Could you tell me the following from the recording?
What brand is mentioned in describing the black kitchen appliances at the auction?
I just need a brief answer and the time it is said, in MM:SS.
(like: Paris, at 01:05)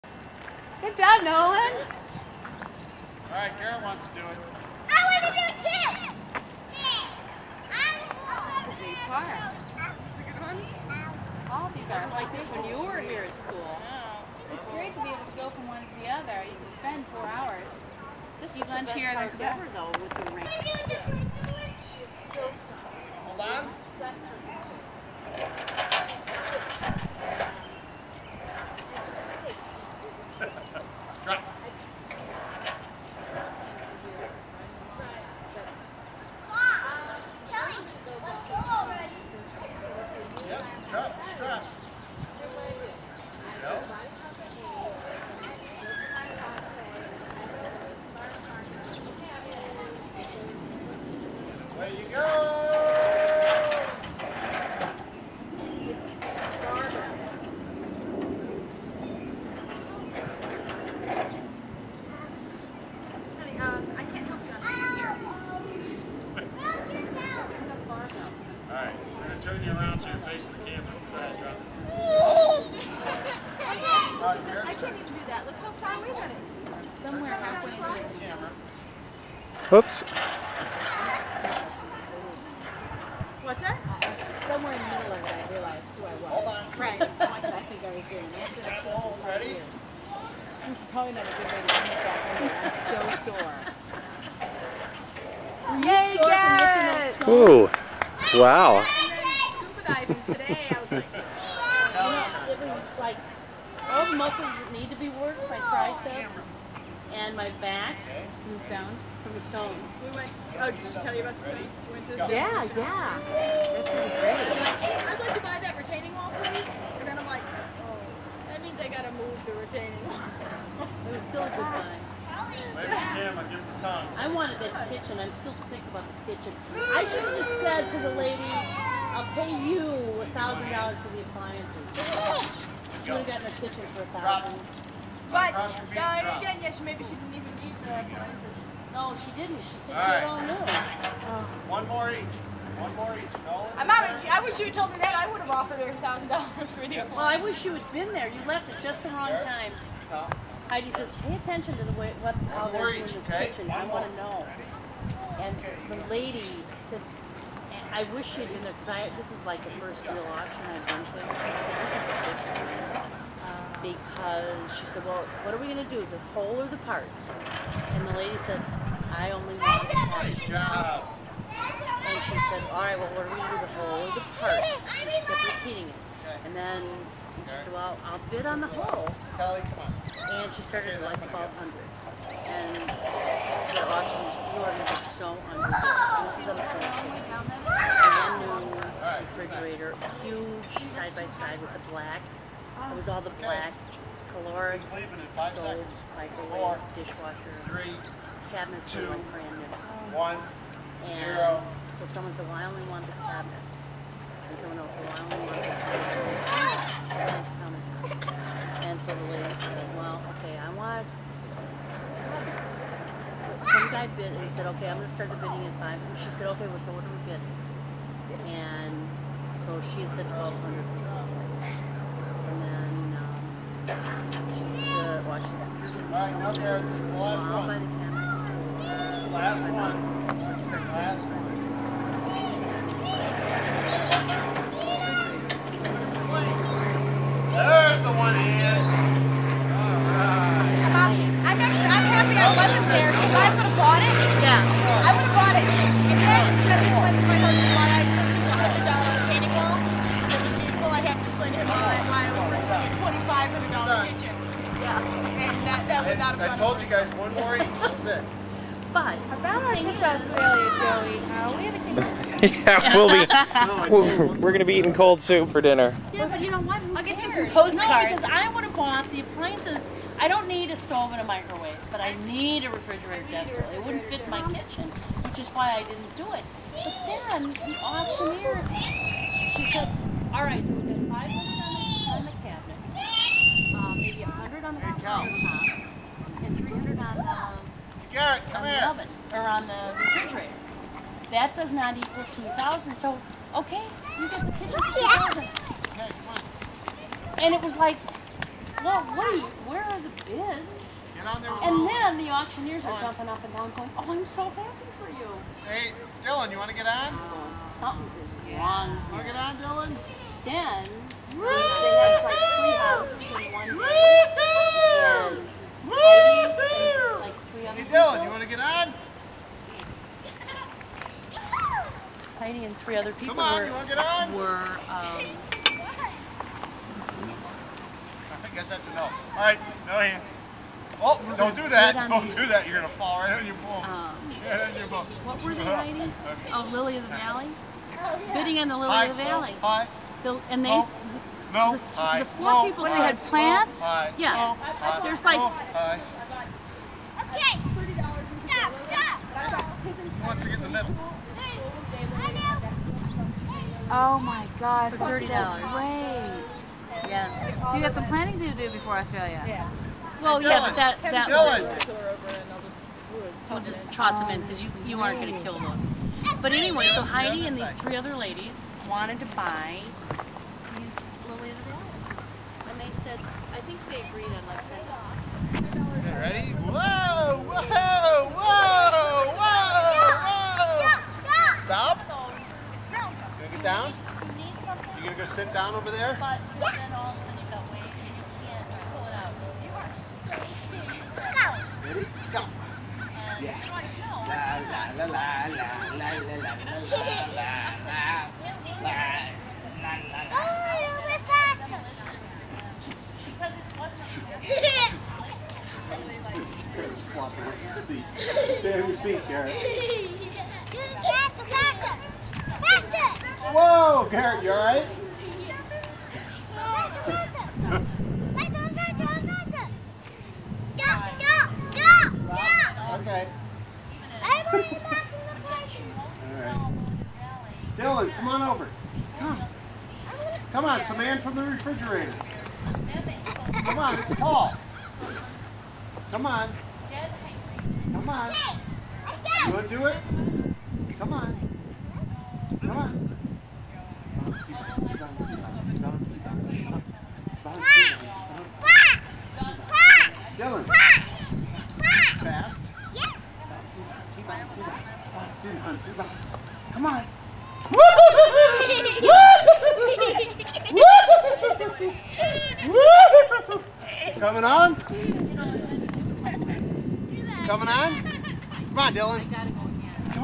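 Caloric, at 03:14.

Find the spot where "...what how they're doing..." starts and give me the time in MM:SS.
02:32.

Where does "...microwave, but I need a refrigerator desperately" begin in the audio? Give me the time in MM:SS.
04:31.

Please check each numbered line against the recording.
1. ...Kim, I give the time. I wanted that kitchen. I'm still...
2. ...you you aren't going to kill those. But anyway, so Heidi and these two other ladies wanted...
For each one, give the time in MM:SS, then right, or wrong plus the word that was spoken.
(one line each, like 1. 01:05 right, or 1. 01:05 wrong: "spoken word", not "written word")
1. 02:02 right
2. 06:04 wrong: "three", not "two".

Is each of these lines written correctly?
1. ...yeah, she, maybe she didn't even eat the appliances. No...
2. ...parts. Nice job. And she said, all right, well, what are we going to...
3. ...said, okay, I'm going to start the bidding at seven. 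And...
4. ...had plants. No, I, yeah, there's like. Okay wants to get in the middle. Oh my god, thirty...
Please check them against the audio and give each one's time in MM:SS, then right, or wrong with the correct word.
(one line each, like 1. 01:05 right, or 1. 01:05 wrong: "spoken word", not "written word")
1. 02:16 right
2. 02:49 right
3. 03:34 wrong: "five", not "seven"
4. 05:42 right.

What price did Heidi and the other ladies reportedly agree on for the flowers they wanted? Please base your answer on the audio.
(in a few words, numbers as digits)
$10.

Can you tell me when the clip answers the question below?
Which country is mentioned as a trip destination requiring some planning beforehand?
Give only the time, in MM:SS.
05:58.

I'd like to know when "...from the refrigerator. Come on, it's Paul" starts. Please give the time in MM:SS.
07:11.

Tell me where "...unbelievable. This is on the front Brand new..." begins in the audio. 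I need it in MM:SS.
03:05.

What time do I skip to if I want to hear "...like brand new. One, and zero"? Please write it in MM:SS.
03:19.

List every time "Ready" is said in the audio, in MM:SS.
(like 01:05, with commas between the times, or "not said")
01:29, 06:16, 06:31.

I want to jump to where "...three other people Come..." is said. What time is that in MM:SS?
05:22.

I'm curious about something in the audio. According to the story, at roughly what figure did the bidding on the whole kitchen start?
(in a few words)
1200.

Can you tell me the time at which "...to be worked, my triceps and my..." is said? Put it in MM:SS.
01:44.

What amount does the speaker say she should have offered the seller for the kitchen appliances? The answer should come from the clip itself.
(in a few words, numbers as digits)
$1,000.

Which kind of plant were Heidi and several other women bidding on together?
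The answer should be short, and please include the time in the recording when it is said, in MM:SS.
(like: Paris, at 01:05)
Lily of the Valley, at 05:36.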